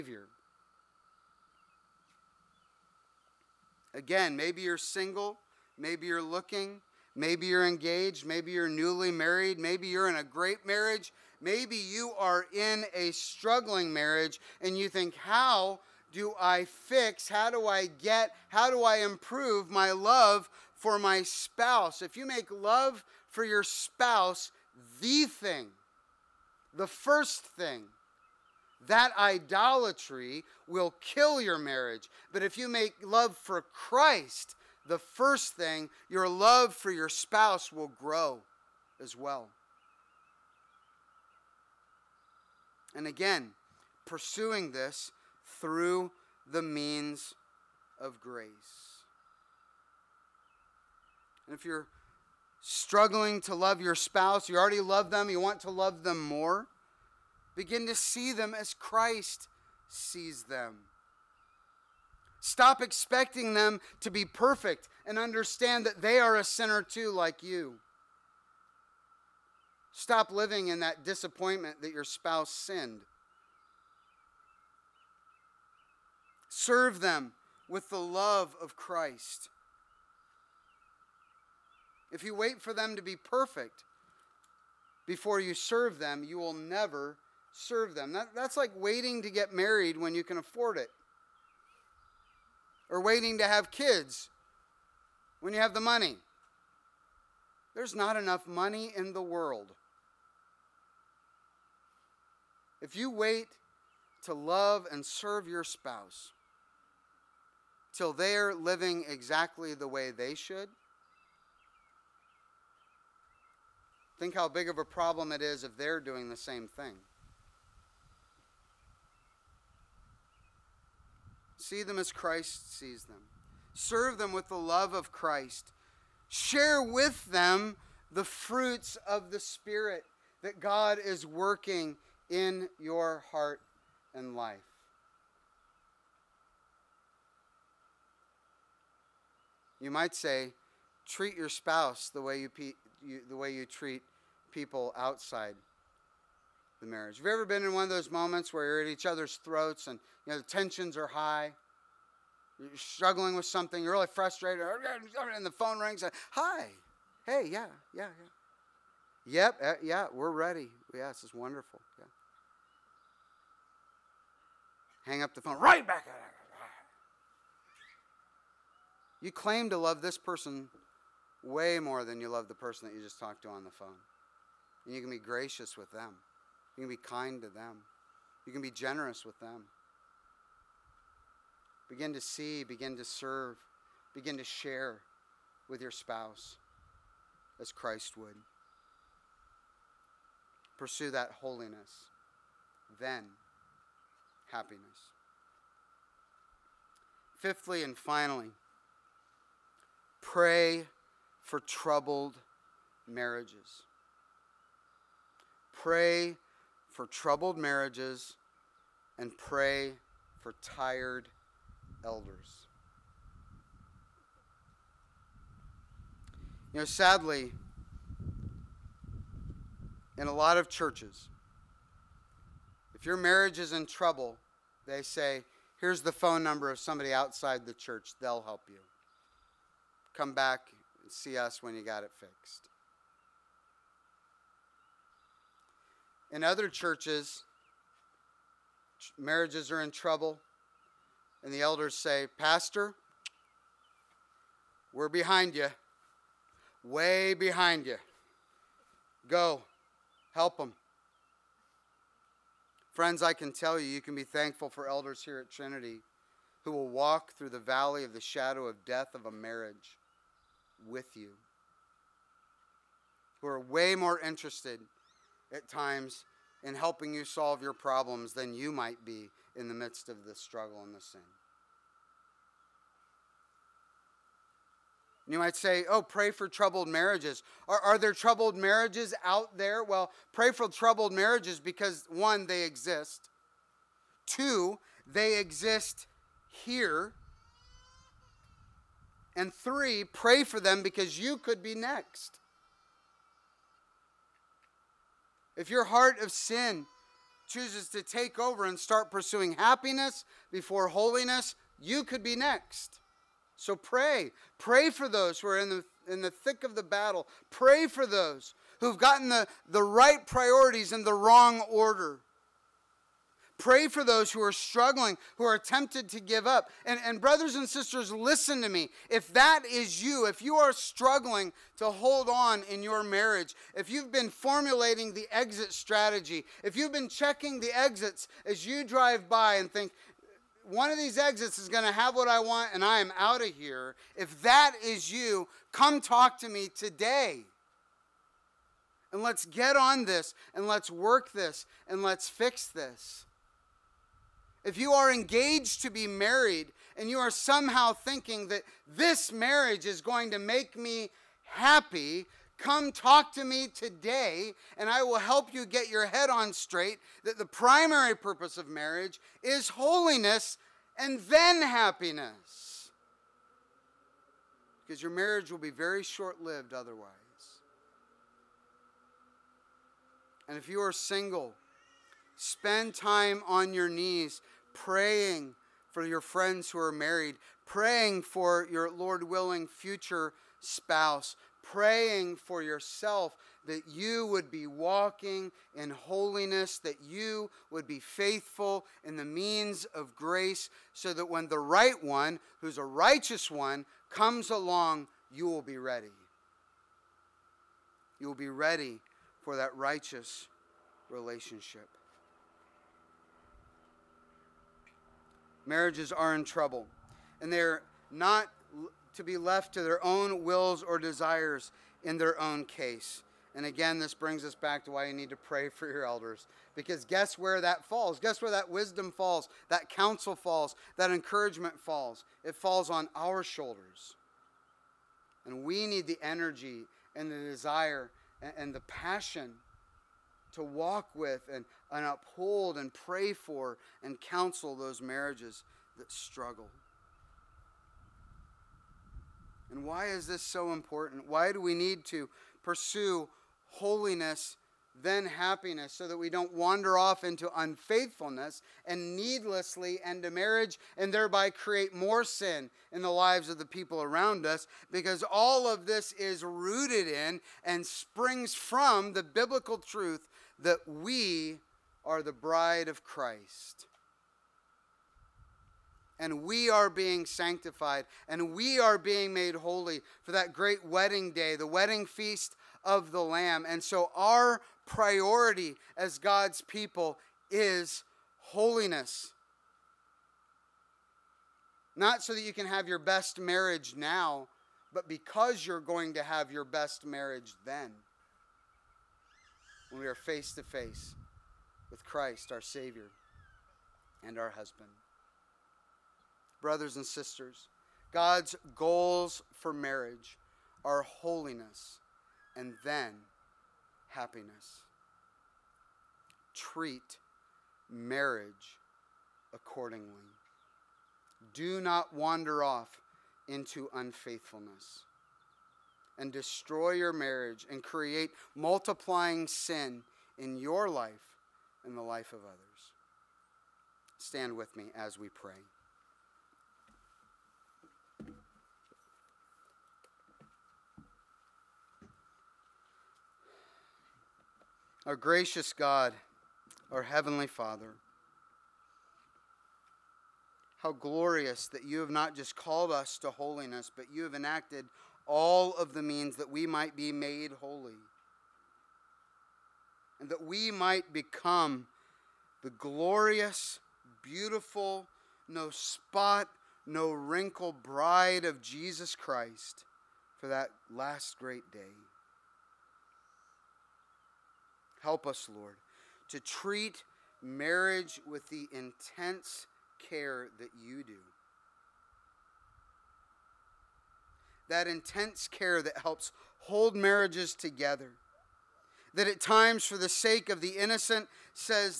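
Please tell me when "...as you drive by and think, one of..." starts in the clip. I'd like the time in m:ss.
5:28.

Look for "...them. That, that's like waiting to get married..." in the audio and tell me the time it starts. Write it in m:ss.
1:27.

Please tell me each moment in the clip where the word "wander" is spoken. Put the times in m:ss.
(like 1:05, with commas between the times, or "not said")
7:26, 8:32.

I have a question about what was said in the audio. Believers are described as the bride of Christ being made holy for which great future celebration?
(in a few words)
The wedding feast of the Lamb.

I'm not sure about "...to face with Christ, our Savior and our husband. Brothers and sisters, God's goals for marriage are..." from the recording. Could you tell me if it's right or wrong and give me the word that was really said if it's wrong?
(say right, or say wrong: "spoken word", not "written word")
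right.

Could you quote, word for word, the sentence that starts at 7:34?
Because all of this is rooted in and springs from the biblical truth that we are the bride of Christ.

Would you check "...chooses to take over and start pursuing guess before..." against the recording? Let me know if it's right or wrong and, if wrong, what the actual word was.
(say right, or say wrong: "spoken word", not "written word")
wrong: "happiness", not "guess".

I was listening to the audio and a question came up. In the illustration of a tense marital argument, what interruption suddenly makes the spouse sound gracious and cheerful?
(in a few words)
The phone rings.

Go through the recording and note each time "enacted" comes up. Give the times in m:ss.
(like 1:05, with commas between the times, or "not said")
9:04.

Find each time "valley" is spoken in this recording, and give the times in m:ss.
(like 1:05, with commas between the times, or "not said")
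4:17.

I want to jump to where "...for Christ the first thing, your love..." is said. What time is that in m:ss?
0:33.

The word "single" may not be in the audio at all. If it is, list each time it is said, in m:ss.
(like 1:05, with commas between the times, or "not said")
0:04, 6:10.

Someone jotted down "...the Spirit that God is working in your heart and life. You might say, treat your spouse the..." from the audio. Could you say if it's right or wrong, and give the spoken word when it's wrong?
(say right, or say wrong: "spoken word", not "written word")
right.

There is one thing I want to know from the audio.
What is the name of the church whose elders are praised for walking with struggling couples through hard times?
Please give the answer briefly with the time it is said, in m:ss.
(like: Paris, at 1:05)
Trinity, at 4:15.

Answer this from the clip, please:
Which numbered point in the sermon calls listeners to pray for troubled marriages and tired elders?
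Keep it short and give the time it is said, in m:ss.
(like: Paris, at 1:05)
Fifthly, at 3:17.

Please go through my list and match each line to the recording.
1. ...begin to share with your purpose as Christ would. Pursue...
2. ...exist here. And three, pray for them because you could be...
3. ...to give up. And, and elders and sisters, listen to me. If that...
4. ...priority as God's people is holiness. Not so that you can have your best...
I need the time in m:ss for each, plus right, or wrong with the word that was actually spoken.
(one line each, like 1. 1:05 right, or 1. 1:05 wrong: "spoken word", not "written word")
1. 3:04 wrong: "spouse", not "purpose"
2. 4:45 right
3. 5:16 wrong: "brothers", not "elders"
4. 7:54 right.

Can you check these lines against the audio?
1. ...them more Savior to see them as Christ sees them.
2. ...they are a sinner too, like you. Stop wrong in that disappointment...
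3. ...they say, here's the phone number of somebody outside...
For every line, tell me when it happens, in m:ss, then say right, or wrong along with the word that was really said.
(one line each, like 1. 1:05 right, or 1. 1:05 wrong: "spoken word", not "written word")
1. 0:56 wrong: "Begin", not "Savior"
2. 1:05 wrong: "living", not "wrong"
3. 3:44 right.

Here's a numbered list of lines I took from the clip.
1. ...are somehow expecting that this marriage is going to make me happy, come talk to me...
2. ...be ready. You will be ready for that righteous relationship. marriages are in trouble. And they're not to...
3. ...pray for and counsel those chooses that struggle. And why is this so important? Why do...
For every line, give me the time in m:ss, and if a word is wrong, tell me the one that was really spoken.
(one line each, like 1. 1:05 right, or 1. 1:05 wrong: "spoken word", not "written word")
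1. 5:47 wrong: "thinking", not "expecting"
2. 6:35 right
3. 7:12 wrong: "marriages", not "chooses".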